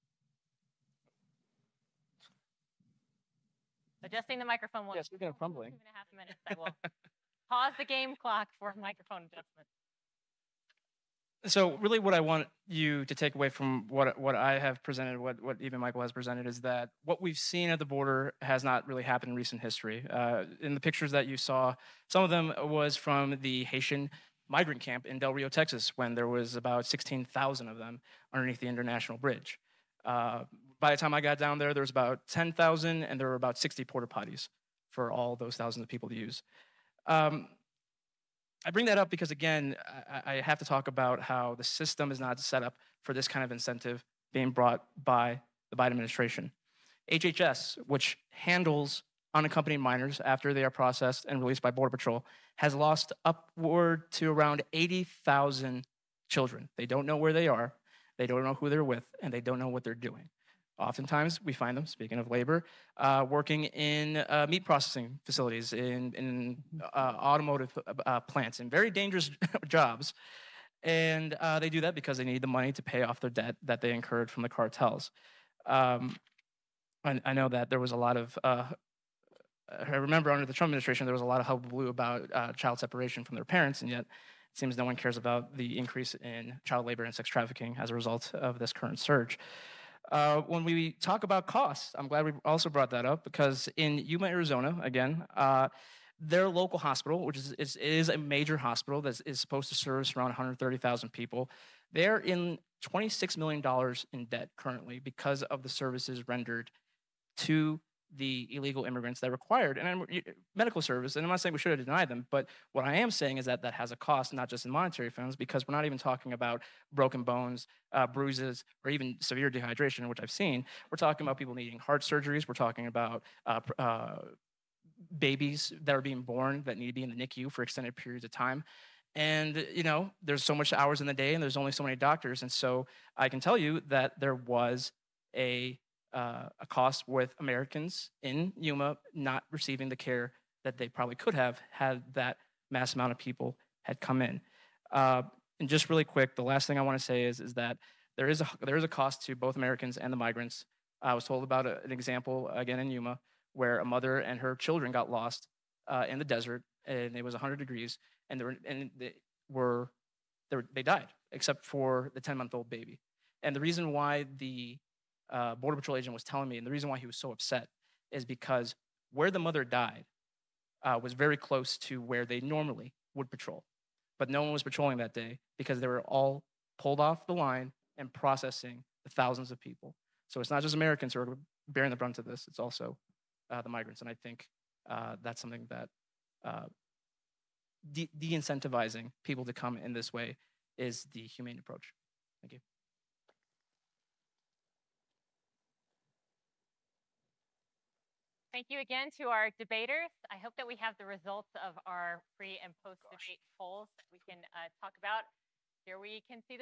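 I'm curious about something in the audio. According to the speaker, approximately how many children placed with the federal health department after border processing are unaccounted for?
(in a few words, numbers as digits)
80,000.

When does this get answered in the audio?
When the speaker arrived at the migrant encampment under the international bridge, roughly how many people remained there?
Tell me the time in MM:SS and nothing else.
00:31.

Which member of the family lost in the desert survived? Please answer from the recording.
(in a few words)
10 month old baby.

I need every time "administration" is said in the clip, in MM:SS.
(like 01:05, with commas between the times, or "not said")
00:45, 01:20.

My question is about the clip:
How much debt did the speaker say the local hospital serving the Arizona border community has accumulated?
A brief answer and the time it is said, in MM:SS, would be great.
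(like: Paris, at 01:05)
$26 million, at 01:42.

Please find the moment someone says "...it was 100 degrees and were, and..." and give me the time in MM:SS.
02:37.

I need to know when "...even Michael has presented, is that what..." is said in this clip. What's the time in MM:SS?
00:15.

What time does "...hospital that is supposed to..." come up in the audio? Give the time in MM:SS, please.
01:38.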